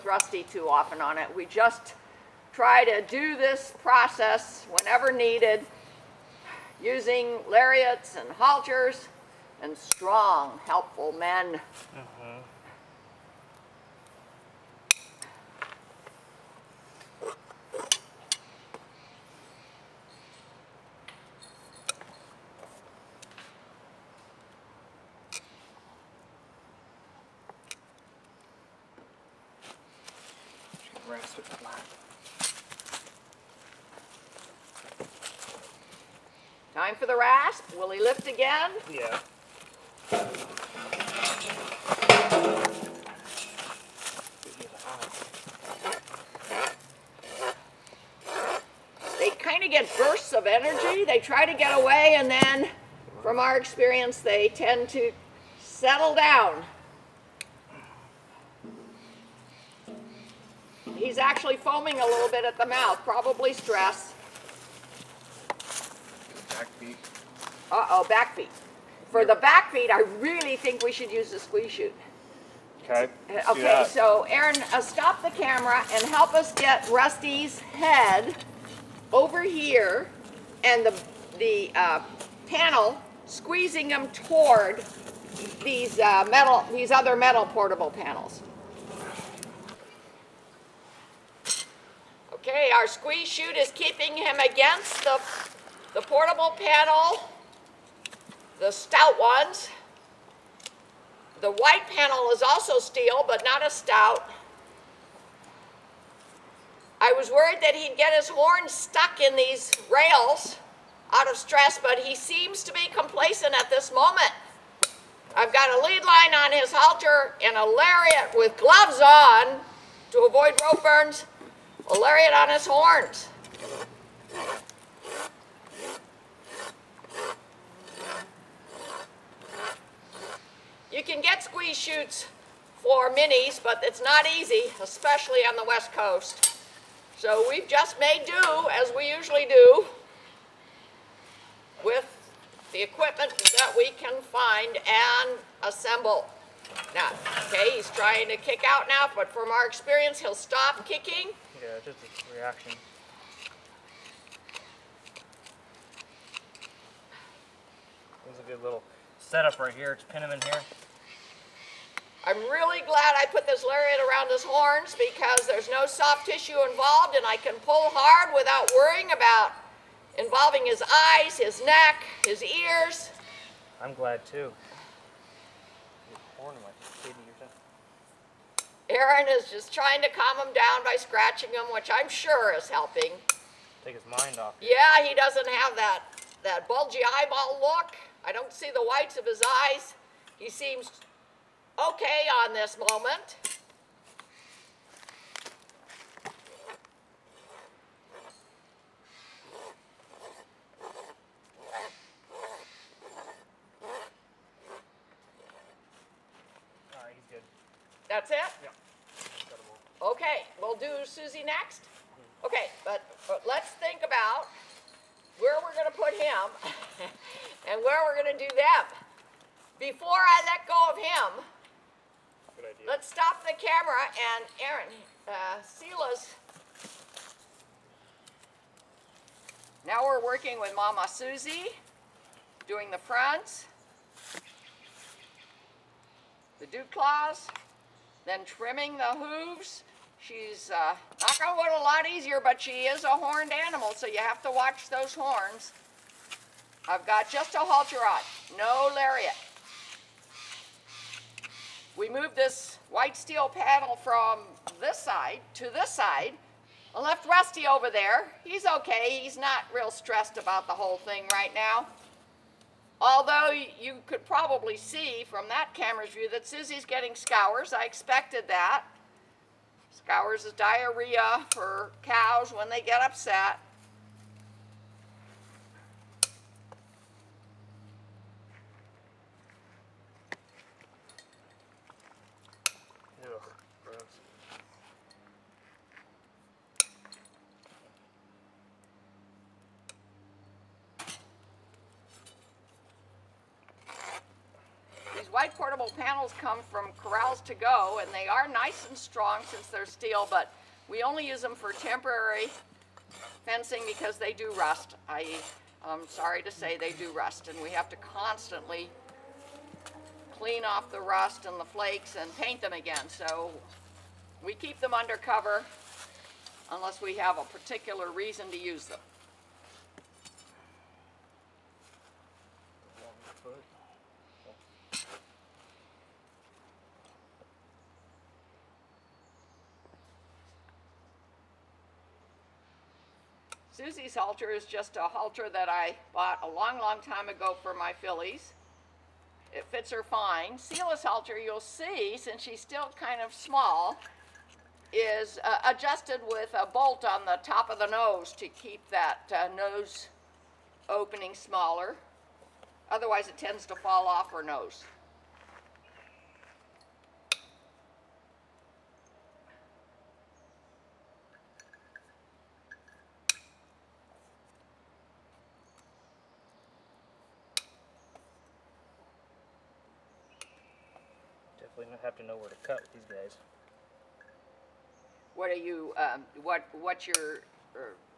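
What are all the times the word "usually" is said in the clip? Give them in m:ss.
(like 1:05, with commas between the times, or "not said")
2:19.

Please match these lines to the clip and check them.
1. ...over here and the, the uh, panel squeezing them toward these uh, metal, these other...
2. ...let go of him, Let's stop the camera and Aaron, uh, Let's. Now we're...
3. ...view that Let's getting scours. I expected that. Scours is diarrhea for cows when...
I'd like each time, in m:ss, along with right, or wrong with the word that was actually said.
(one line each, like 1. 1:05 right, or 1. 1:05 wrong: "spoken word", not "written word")
1. 1:19 right
2. 3:40 wrong: "Seela", not "Let"
3. 4:26 wrong: "Suzie", not "Let".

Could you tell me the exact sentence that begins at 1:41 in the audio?
The white panel is also steel, but not a stout.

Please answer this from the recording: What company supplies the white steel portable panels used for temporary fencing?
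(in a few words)
Corrals to Go.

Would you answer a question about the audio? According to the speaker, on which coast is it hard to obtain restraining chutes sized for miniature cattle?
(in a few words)
West Coast.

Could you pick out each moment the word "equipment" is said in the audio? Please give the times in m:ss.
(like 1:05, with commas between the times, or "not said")
2:22.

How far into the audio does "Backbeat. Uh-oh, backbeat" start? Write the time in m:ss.
1:06.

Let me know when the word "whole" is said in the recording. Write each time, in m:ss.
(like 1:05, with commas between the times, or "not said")
4:20.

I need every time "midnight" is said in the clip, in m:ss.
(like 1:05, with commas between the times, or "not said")
not said.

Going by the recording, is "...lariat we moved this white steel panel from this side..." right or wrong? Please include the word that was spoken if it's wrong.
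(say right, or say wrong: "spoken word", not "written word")
right.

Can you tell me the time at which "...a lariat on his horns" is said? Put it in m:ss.
2:01.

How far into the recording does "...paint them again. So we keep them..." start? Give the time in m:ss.
5:12.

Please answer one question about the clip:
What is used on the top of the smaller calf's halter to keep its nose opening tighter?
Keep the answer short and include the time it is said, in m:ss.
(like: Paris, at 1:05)
a bolt, at 5:46.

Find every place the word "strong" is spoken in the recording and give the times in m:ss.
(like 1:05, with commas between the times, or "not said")
0:09, 4:58.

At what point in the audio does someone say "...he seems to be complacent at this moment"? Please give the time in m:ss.
1:51.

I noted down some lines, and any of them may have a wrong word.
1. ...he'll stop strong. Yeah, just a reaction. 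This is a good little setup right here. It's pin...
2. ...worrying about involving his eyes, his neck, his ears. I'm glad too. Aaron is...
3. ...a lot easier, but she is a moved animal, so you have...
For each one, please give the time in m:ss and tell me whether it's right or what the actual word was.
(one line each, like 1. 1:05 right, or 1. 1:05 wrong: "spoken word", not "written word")
1. 2:30 wrong: "kicking", not "strong"
2. 2:48 right
3. 4:01 wrong: "horned", not "moved".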